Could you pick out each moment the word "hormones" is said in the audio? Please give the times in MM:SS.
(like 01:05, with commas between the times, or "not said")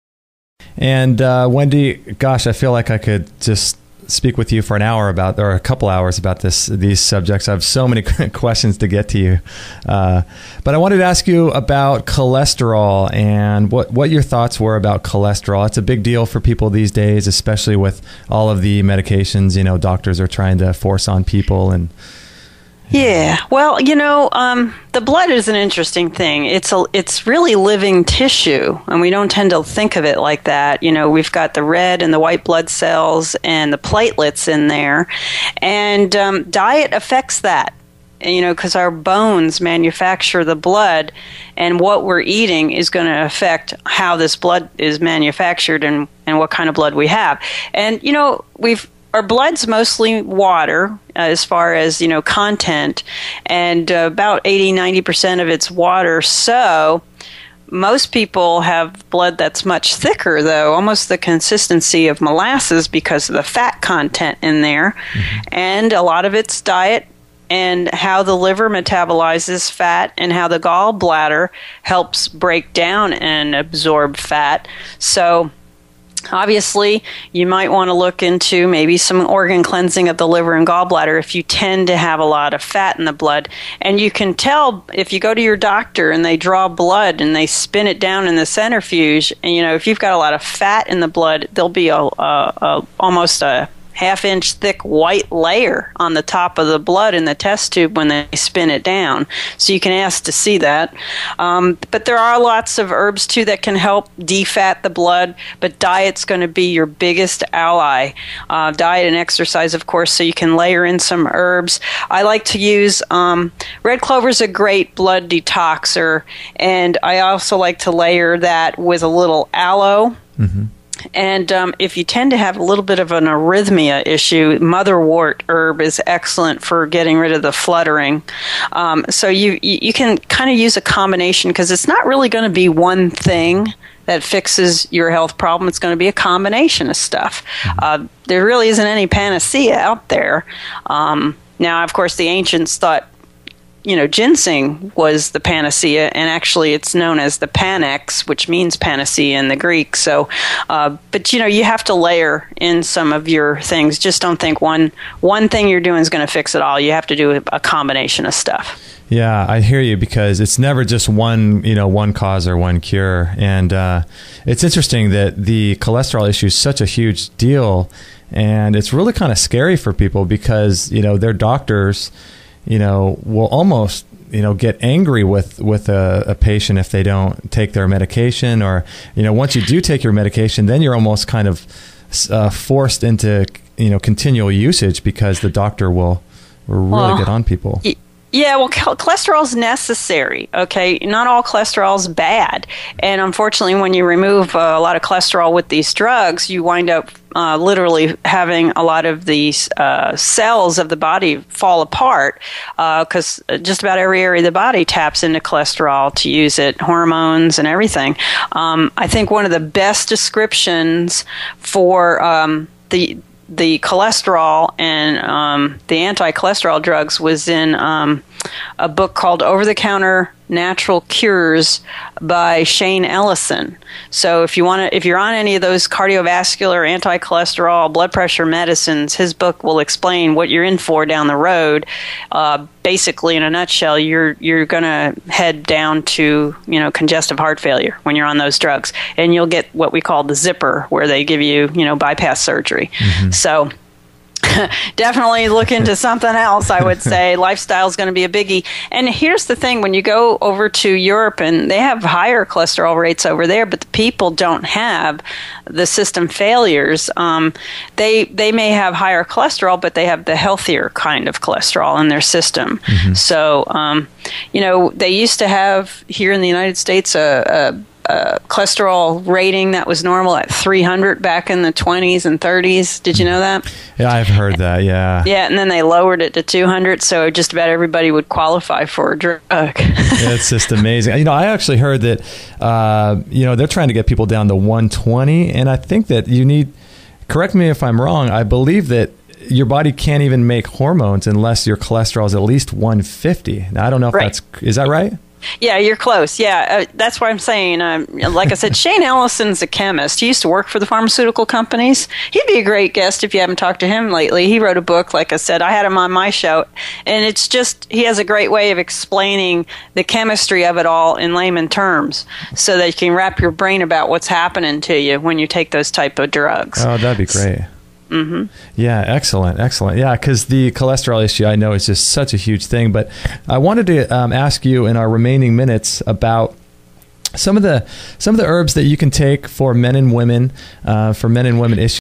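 03:26, 04:50.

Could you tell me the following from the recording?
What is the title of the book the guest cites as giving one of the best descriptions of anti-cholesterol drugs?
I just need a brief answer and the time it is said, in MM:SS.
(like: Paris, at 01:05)
Over the Counter Natural Cures, at 03:39.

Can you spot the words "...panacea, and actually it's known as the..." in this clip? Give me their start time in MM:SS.
02:25.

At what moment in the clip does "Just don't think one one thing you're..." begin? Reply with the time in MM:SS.
02:33.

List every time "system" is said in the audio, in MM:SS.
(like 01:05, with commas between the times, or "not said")
04:15, 04:22.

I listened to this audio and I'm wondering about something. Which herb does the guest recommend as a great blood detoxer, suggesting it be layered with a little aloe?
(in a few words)
red clover.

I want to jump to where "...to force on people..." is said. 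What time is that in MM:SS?
00:20.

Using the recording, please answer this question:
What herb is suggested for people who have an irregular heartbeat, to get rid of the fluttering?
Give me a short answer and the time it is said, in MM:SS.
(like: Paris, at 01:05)
motherwort, at 02:04.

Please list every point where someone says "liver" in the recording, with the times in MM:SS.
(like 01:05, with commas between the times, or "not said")
01:08, 01:20.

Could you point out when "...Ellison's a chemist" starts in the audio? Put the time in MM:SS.
04:59.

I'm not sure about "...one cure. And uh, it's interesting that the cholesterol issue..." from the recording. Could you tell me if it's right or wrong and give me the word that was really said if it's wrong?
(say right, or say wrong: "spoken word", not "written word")
right.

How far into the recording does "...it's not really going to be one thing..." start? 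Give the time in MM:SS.
02:11.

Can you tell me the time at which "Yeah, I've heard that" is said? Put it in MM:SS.
04:33.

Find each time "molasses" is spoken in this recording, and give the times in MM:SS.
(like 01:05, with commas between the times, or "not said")
01:02.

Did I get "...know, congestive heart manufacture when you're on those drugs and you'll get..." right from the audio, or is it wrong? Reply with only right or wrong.
wrong.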